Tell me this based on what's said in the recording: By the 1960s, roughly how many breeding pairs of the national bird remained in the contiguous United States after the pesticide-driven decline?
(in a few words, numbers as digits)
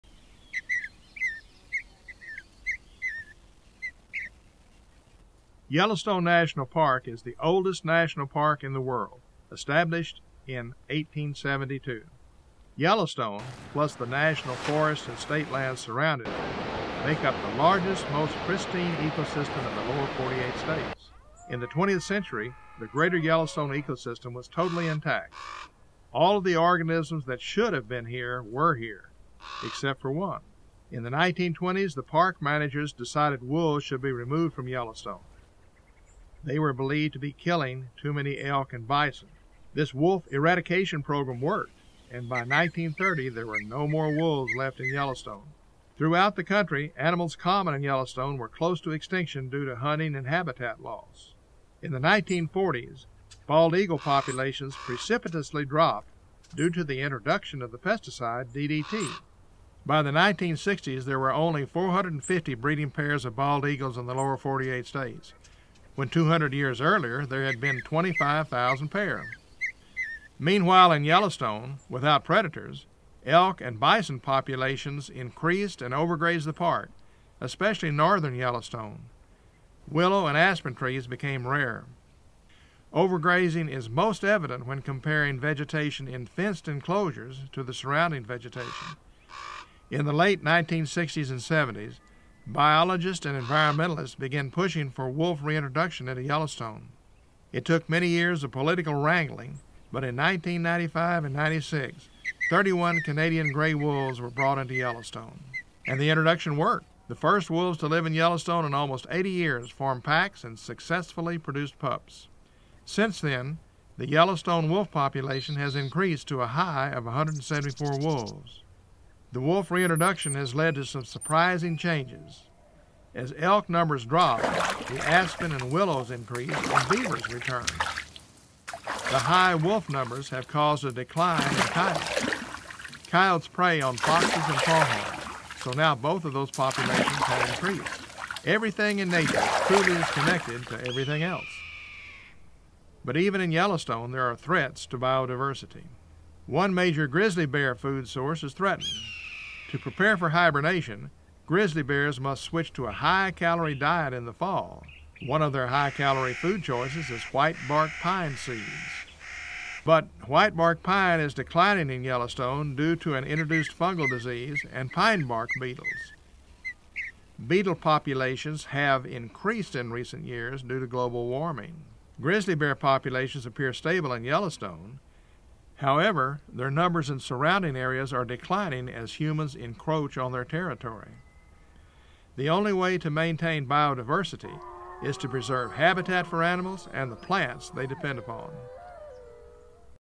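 450.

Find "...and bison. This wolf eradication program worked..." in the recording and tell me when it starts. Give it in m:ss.
0:38.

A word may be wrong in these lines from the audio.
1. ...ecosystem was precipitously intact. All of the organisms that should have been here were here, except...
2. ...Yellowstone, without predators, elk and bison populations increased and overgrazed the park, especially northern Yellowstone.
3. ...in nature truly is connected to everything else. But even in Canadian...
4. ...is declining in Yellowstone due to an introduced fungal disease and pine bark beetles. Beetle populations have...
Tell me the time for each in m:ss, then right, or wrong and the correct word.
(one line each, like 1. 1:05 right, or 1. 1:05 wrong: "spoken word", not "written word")
1. 0:23 wrong: "totally", not "precipitously"
2. 1:11 right
3. 2:18 wrong: "Yellowstone", not "Canadian"
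4. 2:41 right.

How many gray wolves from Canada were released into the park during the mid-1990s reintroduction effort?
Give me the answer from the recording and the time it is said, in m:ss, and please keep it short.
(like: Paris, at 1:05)
31, at 1:42.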